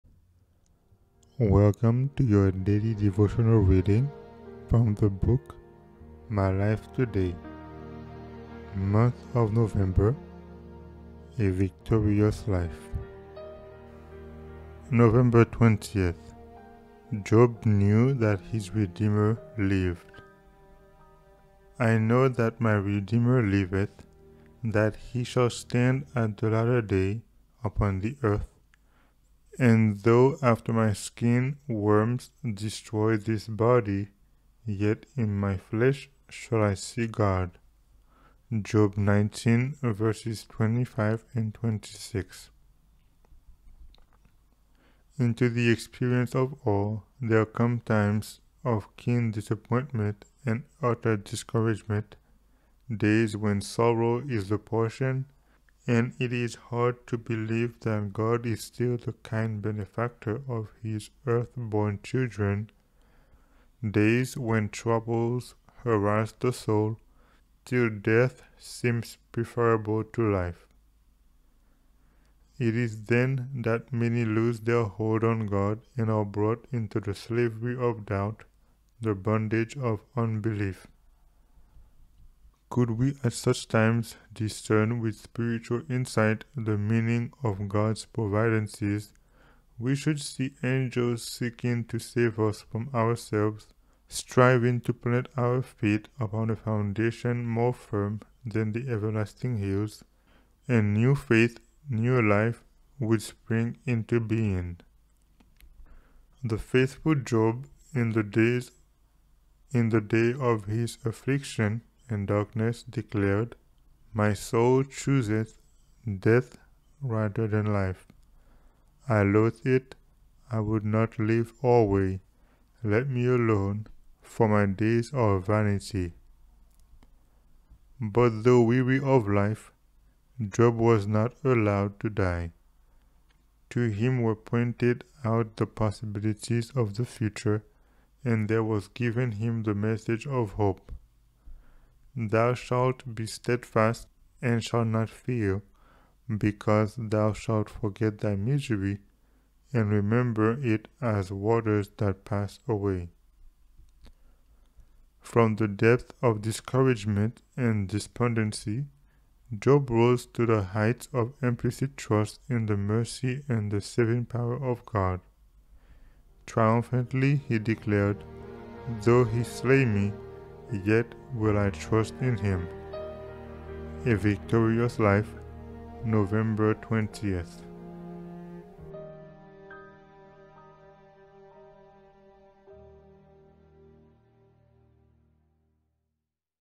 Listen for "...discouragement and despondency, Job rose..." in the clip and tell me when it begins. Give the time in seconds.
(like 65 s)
156 s.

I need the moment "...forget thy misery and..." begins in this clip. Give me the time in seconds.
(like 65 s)
147 s.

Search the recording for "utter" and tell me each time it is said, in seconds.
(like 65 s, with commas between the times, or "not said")
50 s.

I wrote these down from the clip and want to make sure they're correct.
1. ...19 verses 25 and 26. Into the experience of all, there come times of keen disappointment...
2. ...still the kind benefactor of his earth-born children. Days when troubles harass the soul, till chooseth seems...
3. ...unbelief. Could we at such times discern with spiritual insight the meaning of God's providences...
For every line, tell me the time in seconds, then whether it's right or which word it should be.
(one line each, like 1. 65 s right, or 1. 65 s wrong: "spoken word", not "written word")
1. 38 s right
2. 58 s wrong: "death", not "chooseth"
3. 80 s right.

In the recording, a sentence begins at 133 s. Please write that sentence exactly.
To him were pointed out the possibilities of the future, and there was given him the message of hope.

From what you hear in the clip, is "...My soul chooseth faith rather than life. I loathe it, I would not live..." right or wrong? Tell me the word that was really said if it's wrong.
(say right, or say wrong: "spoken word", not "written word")
wrong: "death", not "faith".